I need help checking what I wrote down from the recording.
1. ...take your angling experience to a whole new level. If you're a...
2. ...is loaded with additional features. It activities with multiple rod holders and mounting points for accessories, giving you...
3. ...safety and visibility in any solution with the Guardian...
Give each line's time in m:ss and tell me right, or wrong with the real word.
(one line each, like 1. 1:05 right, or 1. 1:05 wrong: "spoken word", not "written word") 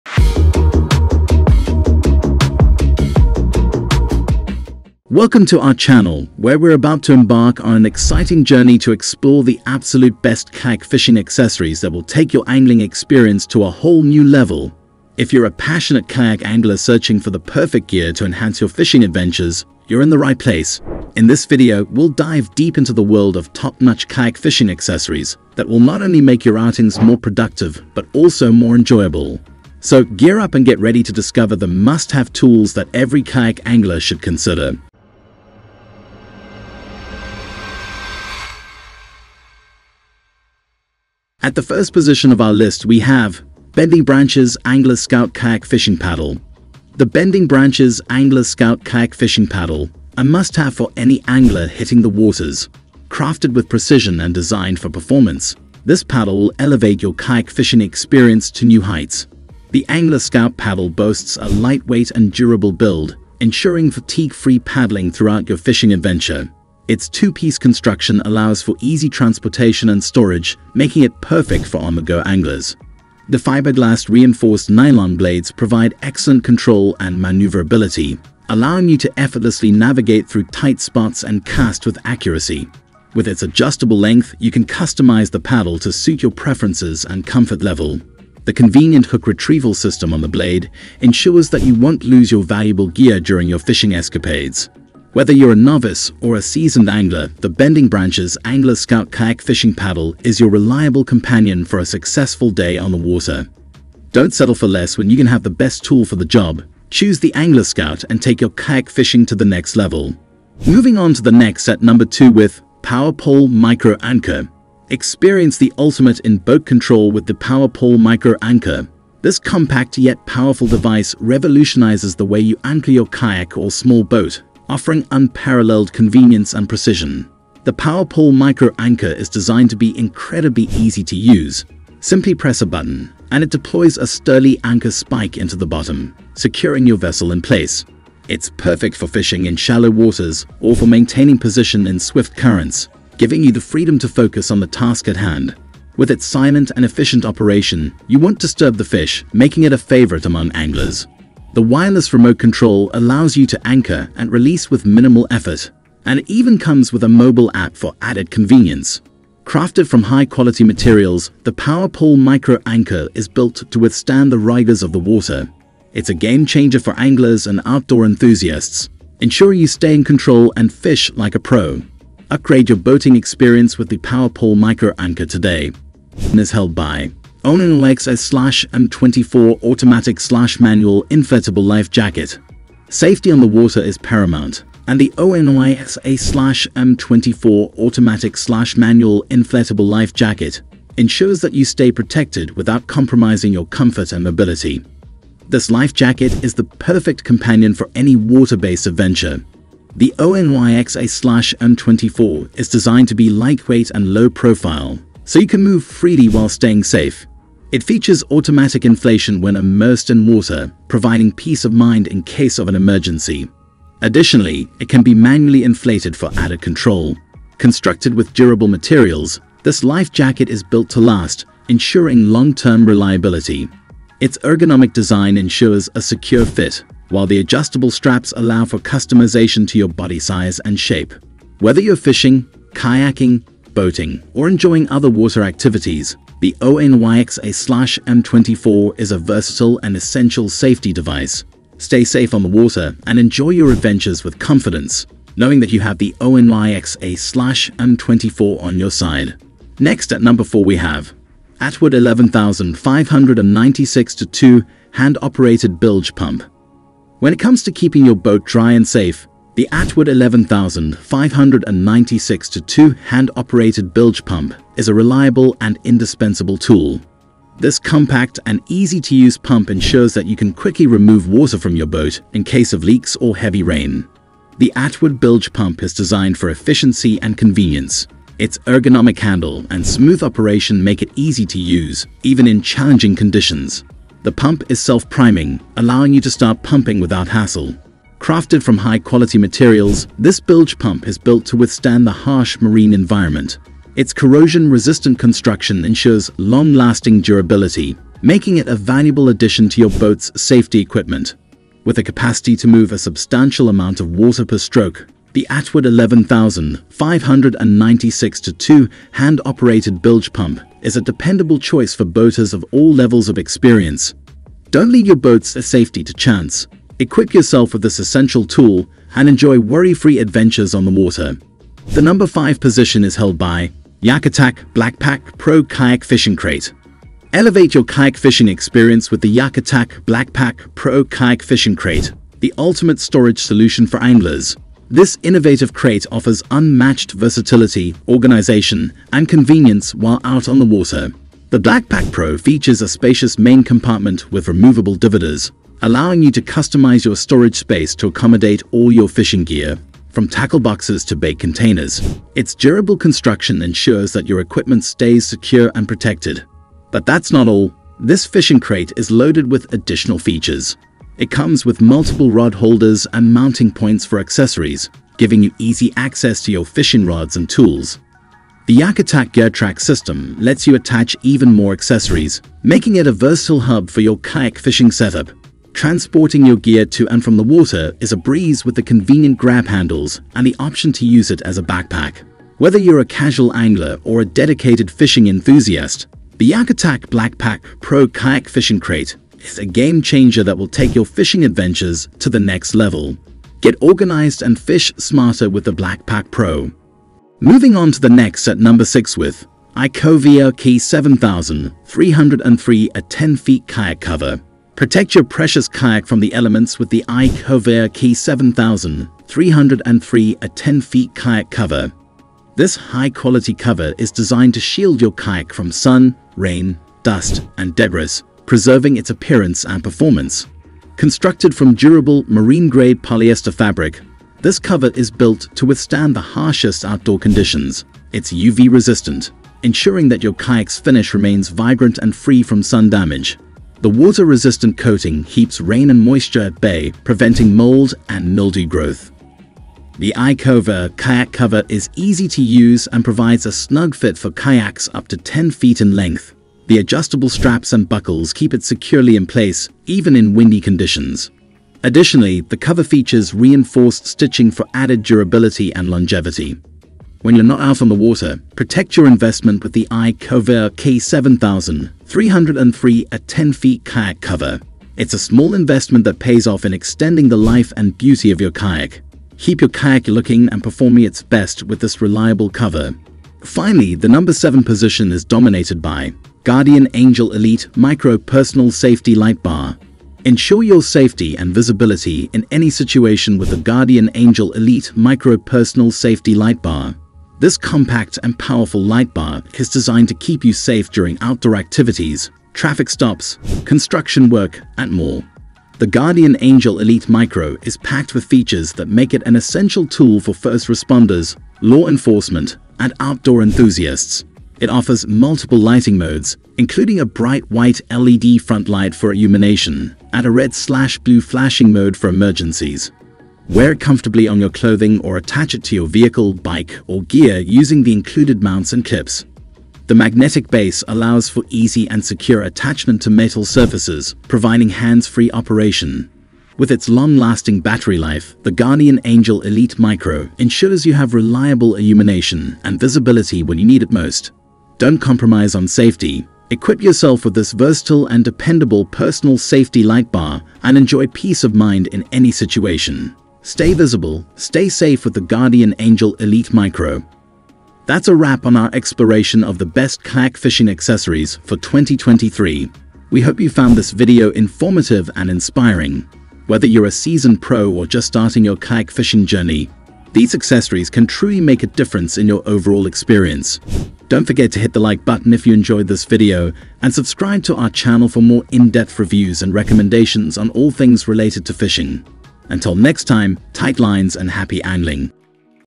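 1. 0:12 right
2. 5:58 wrong: "comes", not "activities"
3. 8:00 wrong: "situation", not "solution".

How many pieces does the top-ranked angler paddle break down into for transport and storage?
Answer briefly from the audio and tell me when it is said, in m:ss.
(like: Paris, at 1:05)
2, at 1:07.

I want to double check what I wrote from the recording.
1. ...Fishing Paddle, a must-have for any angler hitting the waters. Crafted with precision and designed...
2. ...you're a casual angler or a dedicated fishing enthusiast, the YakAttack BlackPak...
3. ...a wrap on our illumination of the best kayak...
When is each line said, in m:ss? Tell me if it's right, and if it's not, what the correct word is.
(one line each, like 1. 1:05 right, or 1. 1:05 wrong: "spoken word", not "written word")
1. 0:49 right
2. 6:22 right
3. 9:08 wrong: "exploration", not "illumination".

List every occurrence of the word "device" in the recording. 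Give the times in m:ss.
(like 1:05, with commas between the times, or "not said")
2:00, 4:00.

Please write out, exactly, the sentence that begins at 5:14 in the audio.
Don't leave your boat's safety to chance.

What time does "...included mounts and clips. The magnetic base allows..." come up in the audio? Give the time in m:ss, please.
8:37.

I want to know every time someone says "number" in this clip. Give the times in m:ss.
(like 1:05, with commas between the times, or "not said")
1:51, 4:10, 5:22, 6:38, 7:54.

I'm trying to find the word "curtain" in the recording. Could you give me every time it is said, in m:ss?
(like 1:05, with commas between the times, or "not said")
not said.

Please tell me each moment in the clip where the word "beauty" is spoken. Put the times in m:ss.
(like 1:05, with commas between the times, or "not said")
7:47.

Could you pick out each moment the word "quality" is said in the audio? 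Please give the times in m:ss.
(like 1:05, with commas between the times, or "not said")
2:40, 4:48, 6:52.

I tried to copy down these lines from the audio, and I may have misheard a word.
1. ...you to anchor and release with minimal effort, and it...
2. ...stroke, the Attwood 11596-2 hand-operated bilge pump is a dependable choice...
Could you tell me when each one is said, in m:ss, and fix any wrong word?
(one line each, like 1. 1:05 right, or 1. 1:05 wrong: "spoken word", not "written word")
1. 2:33 right
2. 5:04 right.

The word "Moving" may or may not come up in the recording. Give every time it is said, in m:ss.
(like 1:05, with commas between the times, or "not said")
1:50, 6:37.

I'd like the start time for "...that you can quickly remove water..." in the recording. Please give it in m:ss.
4:30.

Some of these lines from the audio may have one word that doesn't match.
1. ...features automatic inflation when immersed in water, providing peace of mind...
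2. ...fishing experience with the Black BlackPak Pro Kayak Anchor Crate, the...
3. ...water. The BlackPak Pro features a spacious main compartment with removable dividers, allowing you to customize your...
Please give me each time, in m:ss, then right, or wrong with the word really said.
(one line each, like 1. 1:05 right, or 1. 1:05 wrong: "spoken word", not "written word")
1. 3:27 right
2. 5:28 wrong: "Fishing", not "Anchor"
3. 5:40 right.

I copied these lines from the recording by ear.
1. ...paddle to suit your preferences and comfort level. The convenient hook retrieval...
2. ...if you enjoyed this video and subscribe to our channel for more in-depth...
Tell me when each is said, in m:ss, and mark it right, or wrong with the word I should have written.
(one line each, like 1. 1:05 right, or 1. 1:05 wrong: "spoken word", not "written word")
1. 1:25 right
2. 9:25 right.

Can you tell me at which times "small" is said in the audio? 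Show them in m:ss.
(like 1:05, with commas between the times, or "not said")
2:03, 7:45.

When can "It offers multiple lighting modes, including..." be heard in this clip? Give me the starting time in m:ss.
8:24.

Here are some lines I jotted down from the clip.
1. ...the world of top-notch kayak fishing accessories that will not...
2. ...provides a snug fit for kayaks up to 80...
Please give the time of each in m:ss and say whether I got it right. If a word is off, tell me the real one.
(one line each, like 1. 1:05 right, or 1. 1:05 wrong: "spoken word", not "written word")
1. 0:22 right
2. 7:23 wrong: "10", not "80".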